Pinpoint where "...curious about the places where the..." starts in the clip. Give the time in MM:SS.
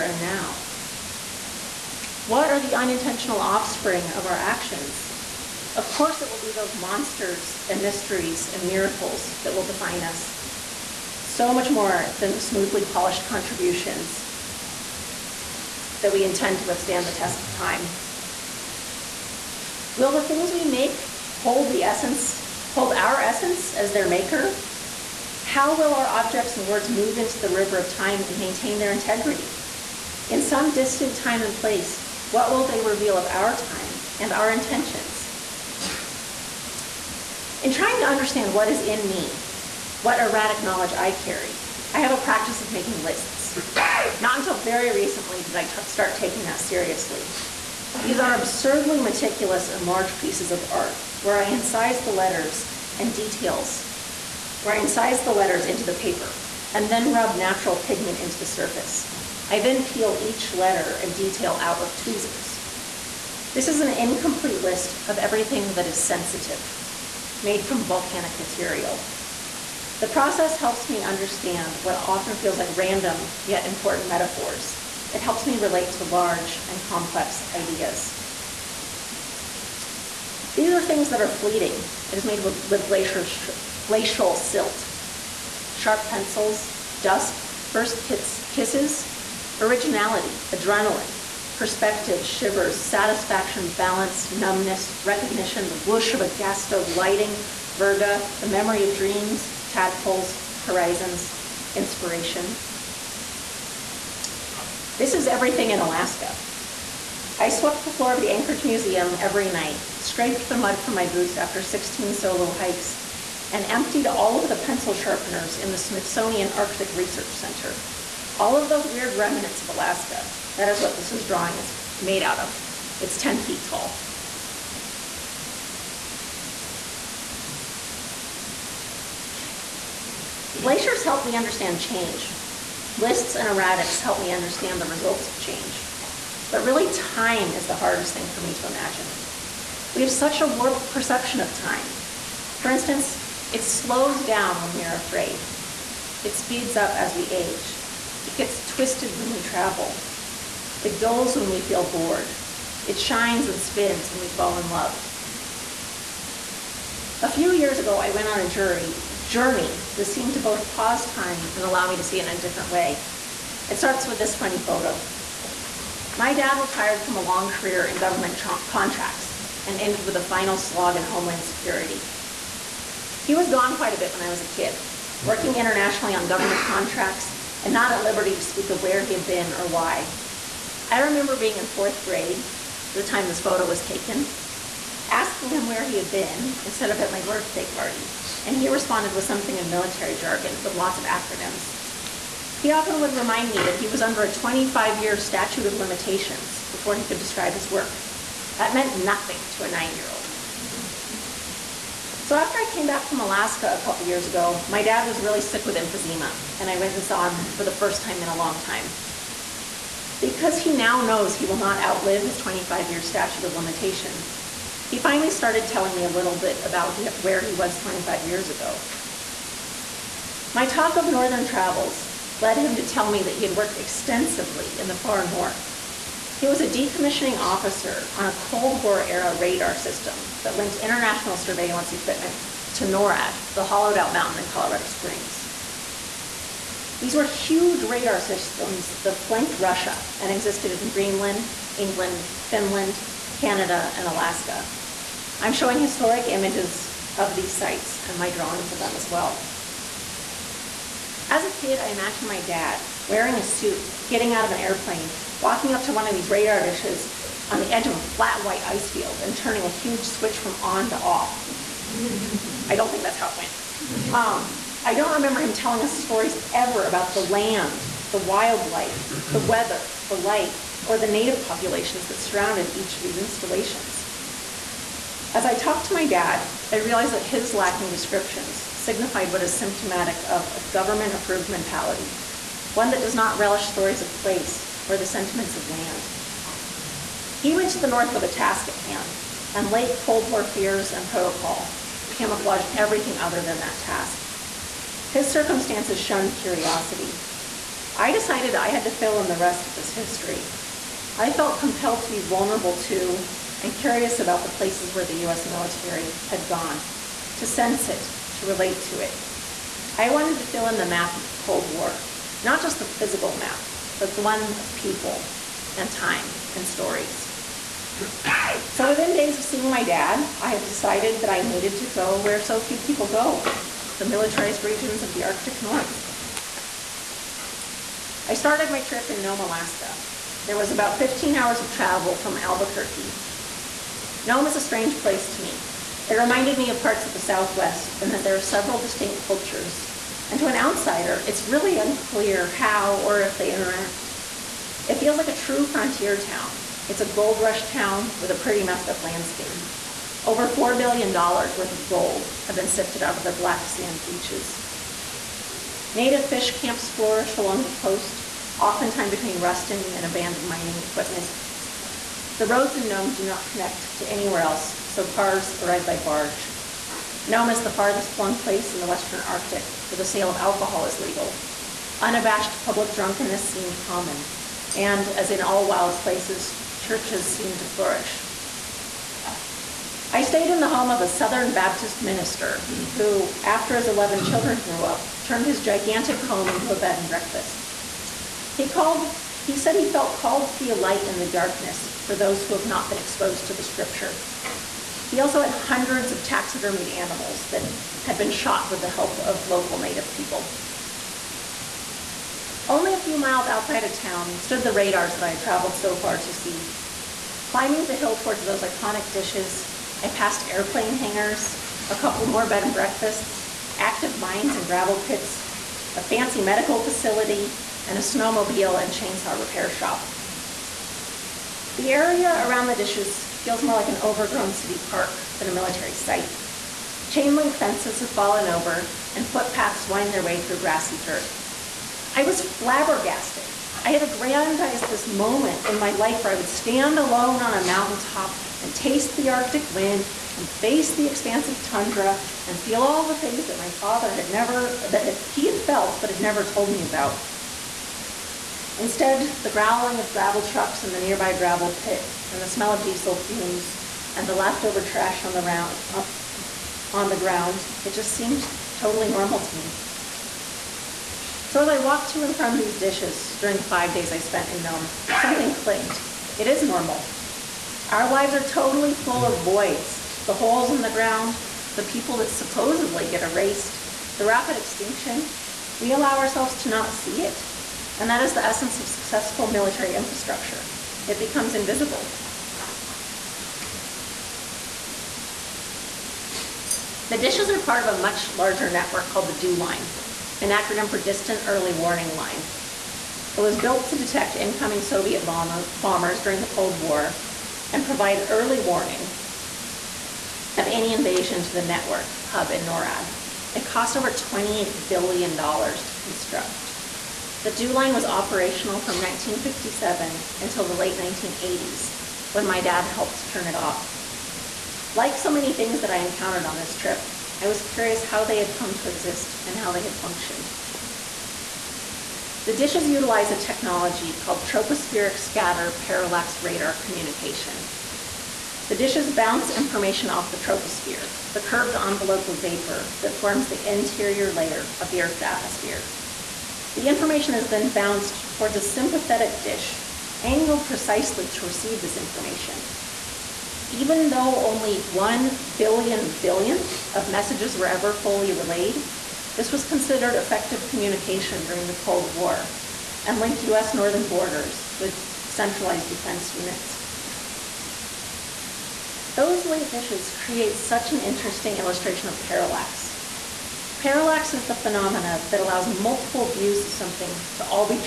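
05:03.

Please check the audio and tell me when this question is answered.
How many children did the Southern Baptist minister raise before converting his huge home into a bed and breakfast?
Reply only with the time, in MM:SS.
06:23.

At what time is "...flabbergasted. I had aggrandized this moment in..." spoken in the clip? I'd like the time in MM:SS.
07:12.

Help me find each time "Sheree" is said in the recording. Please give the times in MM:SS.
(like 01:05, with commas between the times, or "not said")
not said.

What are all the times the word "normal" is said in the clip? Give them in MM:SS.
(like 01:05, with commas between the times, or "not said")
07:39, 07:46.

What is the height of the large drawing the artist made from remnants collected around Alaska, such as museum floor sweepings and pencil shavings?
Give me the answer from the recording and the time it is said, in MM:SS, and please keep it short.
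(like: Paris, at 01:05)
10 feet, at 02:03.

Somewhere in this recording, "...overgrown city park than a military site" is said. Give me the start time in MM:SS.
07:03.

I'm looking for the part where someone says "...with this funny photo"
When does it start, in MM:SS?
02:44.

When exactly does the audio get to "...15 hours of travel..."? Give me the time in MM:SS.
05:30.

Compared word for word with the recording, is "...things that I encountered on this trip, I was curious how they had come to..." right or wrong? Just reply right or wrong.
right.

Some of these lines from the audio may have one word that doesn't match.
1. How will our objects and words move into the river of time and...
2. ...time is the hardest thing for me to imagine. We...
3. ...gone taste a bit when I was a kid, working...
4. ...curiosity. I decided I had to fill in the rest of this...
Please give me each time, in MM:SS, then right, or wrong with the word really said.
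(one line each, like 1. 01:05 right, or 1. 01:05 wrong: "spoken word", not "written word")
1. 00:25 right
2. 02:16 right
3. 02:53 wrong: "quite", not "taste"
4. 04:56 right.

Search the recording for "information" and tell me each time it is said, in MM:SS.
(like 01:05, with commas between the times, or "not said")
08:49, 08:56, 09:01.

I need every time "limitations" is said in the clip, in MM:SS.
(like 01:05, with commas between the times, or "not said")
03:15, 03:33.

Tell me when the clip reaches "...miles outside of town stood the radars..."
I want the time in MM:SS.
06:43.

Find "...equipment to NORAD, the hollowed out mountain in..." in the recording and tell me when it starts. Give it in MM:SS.
03:51.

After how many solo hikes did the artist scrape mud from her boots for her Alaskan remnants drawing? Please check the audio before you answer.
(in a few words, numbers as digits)
16.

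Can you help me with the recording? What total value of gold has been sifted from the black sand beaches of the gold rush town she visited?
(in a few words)
$4 billion.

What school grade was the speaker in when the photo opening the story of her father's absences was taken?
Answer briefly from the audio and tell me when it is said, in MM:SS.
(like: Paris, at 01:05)
fourth grade, at 03:01.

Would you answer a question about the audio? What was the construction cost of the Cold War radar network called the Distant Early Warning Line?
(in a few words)
$28 billion.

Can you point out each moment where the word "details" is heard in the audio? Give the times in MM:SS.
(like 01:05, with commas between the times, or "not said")
00:53, 01:01.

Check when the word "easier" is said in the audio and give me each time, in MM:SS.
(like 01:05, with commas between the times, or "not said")
not said.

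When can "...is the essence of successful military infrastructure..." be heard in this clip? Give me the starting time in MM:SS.
07:58.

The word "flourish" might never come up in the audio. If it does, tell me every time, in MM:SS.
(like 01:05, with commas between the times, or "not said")
05:56, 06:17.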